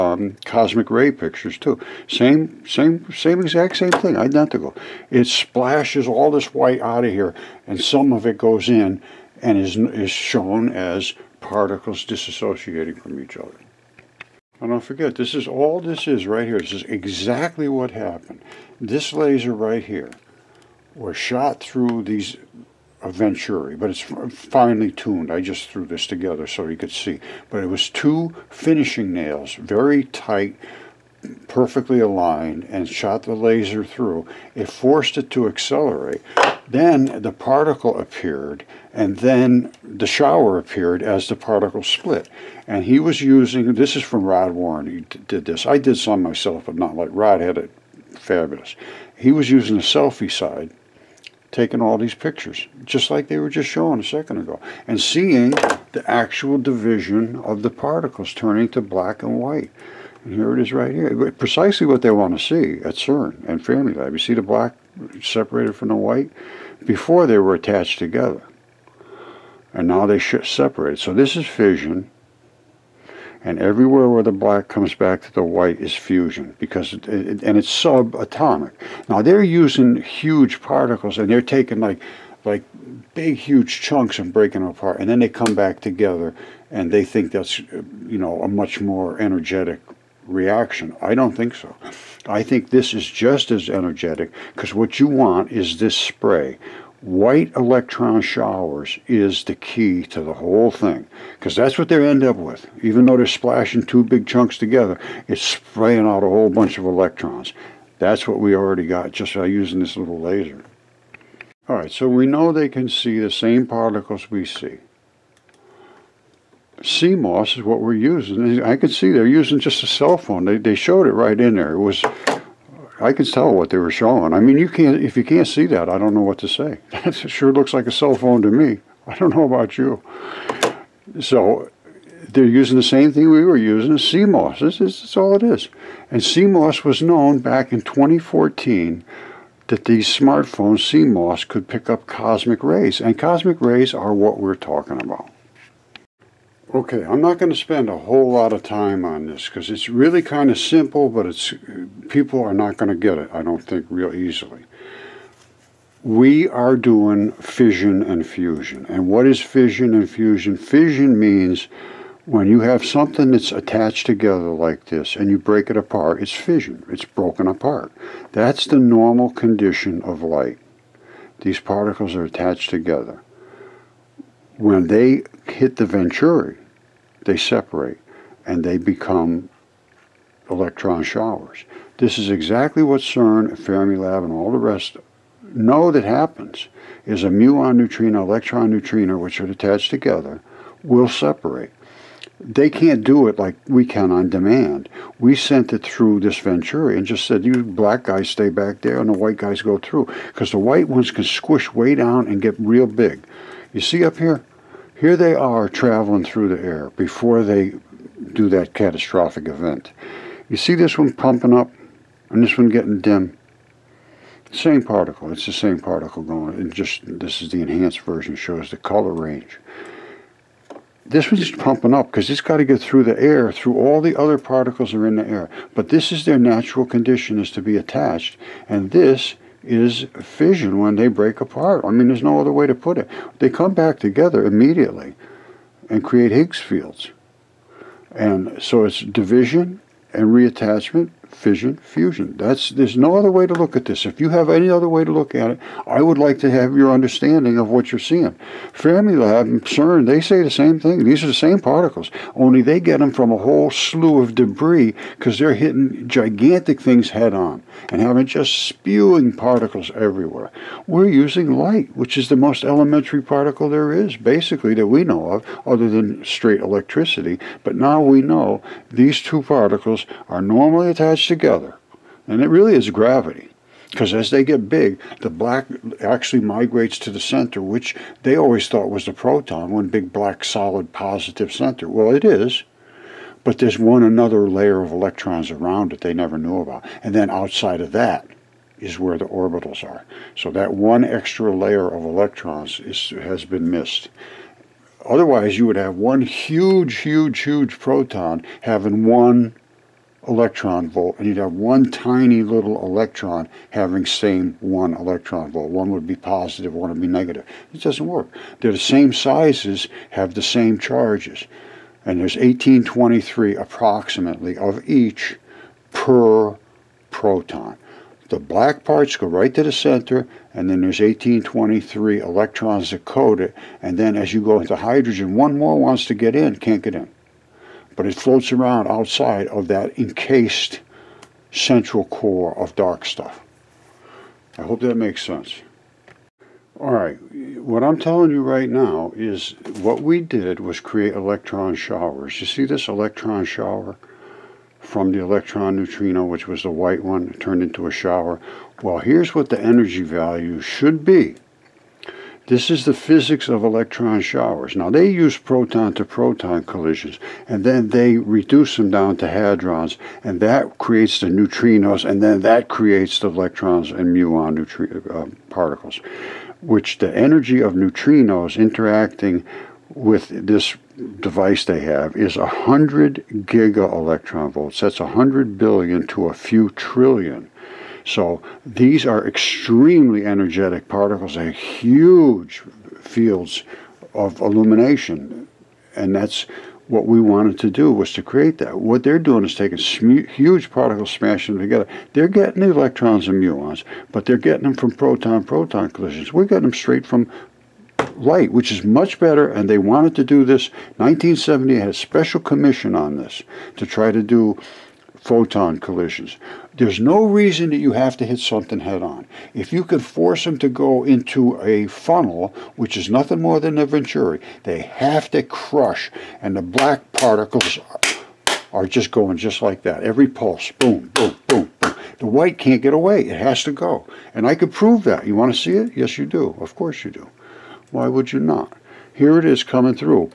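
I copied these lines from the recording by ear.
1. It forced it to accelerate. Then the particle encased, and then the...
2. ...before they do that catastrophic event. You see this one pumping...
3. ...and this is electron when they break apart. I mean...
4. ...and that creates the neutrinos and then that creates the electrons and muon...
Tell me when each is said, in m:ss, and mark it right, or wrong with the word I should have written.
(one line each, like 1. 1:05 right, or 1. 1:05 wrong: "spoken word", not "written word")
1. 0:34 wrong: "appeared", not "encased"
2. 3:26 right
3. 3:48 wrong: "fission", not "electron"
4. 6:00 right.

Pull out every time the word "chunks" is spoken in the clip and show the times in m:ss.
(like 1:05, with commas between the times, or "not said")
1:23, 1:44.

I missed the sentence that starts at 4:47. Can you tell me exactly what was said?
And then outside of that is where the orbitals are.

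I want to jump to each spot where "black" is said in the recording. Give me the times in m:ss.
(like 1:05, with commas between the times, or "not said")
0:58, 1:04, 1:14, 3:17, 4:35, 4:40, 5:18, 6:56.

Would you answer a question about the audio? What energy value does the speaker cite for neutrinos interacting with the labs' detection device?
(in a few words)
100 giga electron volts.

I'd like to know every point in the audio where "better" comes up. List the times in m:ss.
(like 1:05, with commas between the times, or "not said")
6:39.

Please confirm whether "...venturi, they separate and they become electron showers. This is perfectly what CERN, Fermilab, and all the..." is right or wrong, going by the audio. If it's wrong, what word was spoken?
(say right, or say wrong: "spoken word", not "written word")
wrong: "exactly", not "perfectly".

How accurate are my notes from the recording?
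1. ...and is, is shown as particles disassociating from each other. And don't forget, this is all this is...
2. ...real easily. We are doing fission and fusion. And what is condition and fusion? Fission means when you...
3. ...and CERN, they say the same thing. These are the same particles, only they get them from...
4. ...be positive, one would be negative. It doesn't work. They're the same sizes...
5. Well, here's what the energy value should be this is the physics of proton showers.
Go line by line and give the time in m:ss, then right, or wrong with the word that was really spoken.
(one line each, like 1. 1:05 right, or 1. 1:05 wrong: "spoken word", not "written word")
1. 0:09 right
2. 2:33 wrong: "fission", not "condition"
3. 4:09 right
4. 5:06 right
5. 5:48 wrong: "electron", not "proton".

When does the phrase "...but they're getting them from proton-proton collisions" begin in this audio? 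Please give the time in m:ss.
6:34.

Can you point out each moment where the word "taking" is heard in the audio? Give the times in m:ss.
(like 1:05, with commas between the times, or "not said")
0:51, 1:21, 6:29.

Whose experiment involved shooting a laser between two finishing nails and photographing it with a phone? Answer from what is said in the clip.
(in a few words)
Rod Warren.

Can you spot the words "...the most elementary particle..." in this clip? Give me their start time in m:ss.
4:22.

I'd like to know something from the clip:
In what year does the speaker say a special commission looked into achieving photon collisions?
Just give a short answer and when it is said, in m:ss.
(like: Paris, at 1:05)
1970, at 6:40.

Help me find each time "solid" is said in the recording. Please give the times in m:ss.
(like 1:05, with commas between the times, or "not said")
4:40.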